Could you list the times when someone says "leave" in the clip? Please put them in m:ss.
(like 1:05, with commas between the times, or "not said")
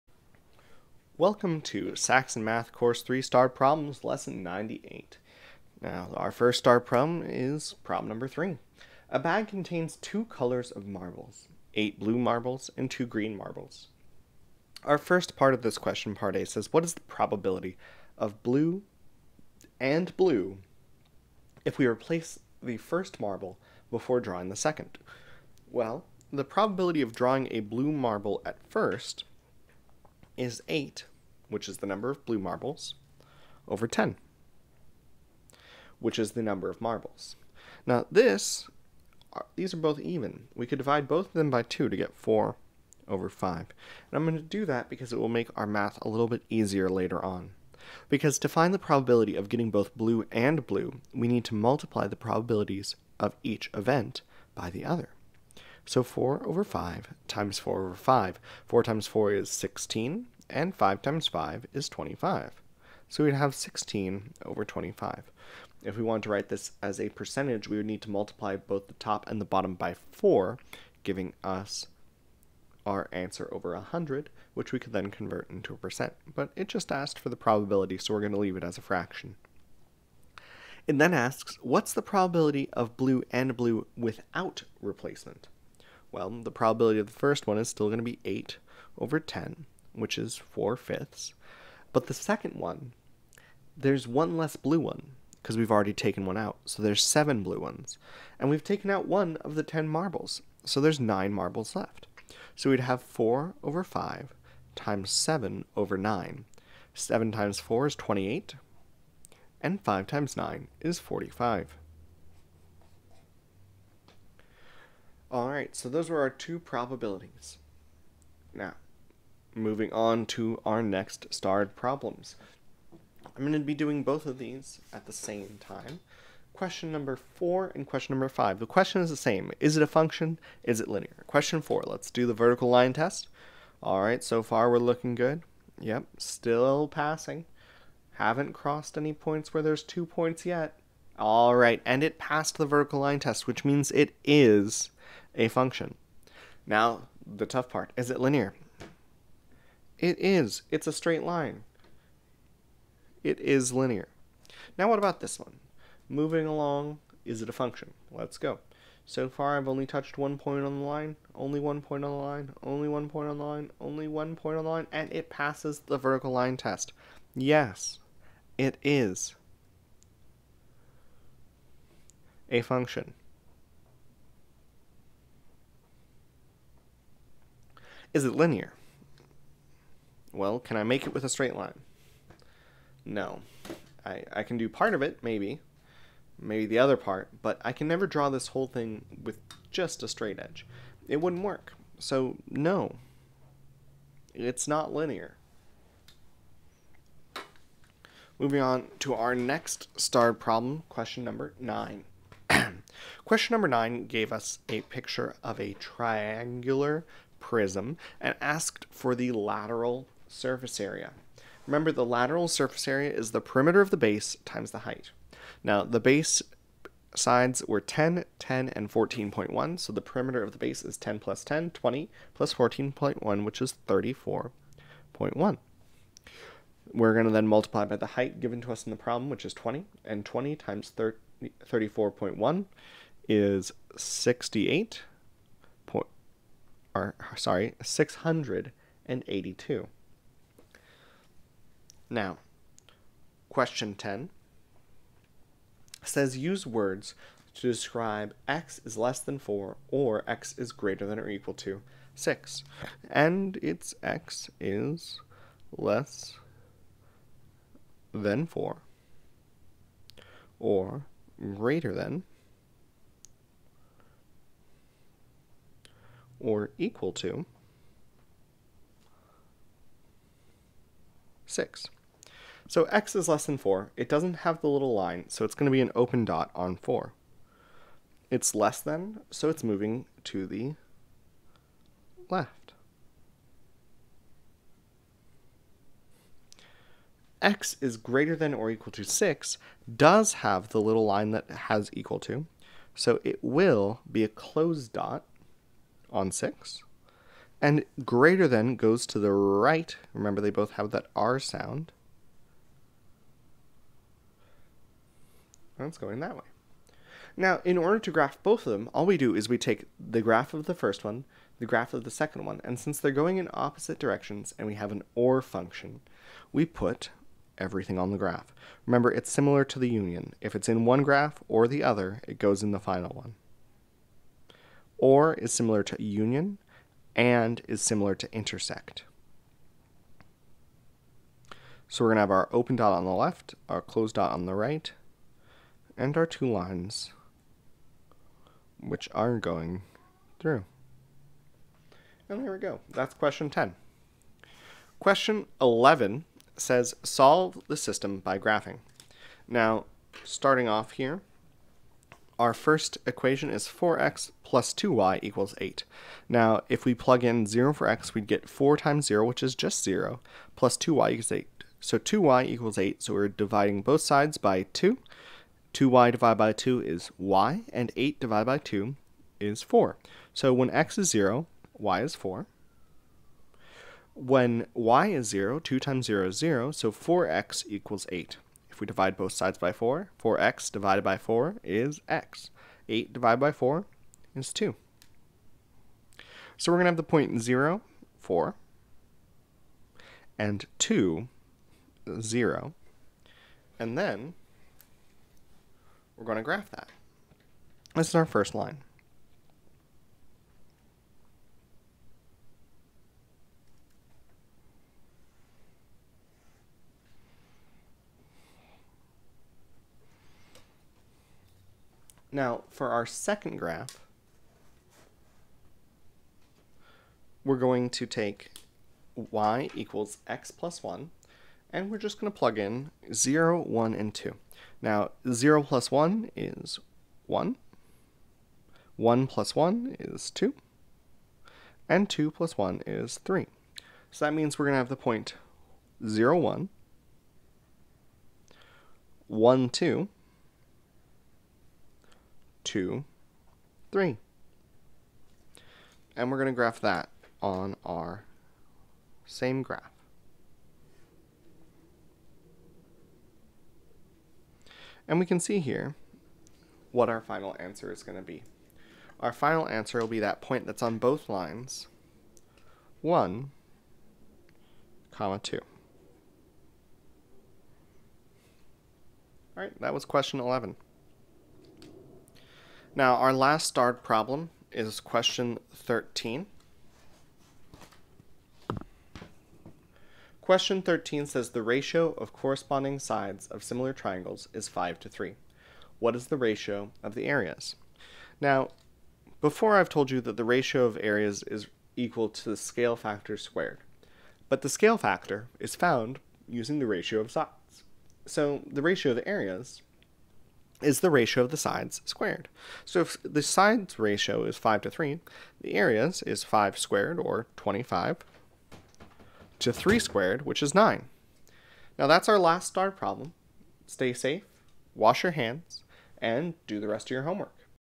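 1:18.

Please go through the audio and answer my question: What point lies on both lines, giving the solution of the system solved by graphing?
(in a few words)
(1, 2).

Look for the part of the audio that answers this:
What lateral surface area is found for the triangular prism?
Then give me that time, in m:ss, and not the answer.
3:57.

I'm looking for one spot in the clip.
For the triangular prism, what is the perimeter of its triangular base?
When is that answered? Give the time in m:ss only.
3:43.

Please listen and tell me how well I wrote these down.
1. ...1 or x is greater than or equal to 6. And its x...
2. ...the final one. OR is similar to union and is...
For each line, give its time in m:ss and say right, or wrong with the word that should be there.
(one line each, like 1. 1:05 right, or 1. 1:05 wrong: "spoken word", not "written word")
1. 4:09 wrong: "4", not "1"
2. 5:22 right.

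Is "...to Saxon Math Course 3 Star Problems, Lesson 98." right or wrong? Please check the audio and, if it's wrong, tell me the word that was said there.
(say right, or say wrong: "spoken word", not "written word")
right.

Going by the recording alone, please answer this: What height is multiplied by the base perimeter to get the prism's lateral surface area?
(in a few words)
20.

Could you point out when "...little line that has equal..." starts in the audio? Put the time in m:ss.
4:50.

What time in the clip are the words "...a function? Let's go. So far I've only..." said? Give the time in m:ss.
2:37.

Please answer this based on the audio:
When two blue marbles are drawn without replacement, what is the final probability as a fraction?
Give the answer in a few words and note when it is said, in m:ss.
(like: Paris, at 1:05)
28/45, at 1:47.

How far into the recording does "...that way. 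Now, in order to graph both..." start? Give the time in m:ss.
5:06.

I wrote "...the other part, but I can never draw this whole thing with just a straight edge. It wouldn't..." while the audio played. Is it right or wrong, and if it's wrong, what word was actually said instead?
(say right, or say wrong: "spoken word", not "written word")
right.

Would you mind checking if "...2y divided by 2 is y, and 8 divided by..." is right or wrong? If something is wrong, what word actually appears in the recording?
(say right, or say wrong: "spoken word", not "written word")
right.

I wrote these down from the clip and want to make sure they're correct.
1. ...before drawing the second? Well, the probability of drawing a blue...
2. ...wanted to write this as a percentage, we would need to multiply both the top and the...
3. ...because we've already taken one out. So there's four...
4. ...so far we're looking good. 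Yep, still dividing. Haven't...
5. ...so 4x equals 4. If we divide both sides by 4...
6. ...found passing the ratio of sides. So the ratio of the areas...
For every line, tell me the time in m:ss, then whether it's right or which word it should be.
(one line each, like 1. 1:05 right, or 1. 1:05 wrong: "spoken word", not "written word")
1. 0:23 right
2. 1:06 right
3. 1:35 wrong: "seven", not "four"
4. 2:14 wrong: "passing", not "dividing"
5. 6:16 wrong: "8", not "4"
6. 8:15 wrong: "using", not "passing".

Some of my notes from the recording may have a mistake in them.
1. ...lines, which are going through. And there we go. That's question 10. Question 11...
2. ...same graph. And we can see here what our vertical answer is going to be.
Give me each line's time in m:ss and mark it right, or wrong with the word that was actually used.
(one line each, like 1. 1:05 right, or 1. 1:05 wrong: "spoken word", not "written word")
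1. 5:36 right
2. 7:29 wrong: "final", not "vertical".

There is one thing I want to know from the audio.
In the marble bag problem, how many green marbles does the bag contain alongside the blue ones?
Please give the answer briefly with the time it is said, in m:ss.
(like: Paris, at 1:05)
2, at 0:12.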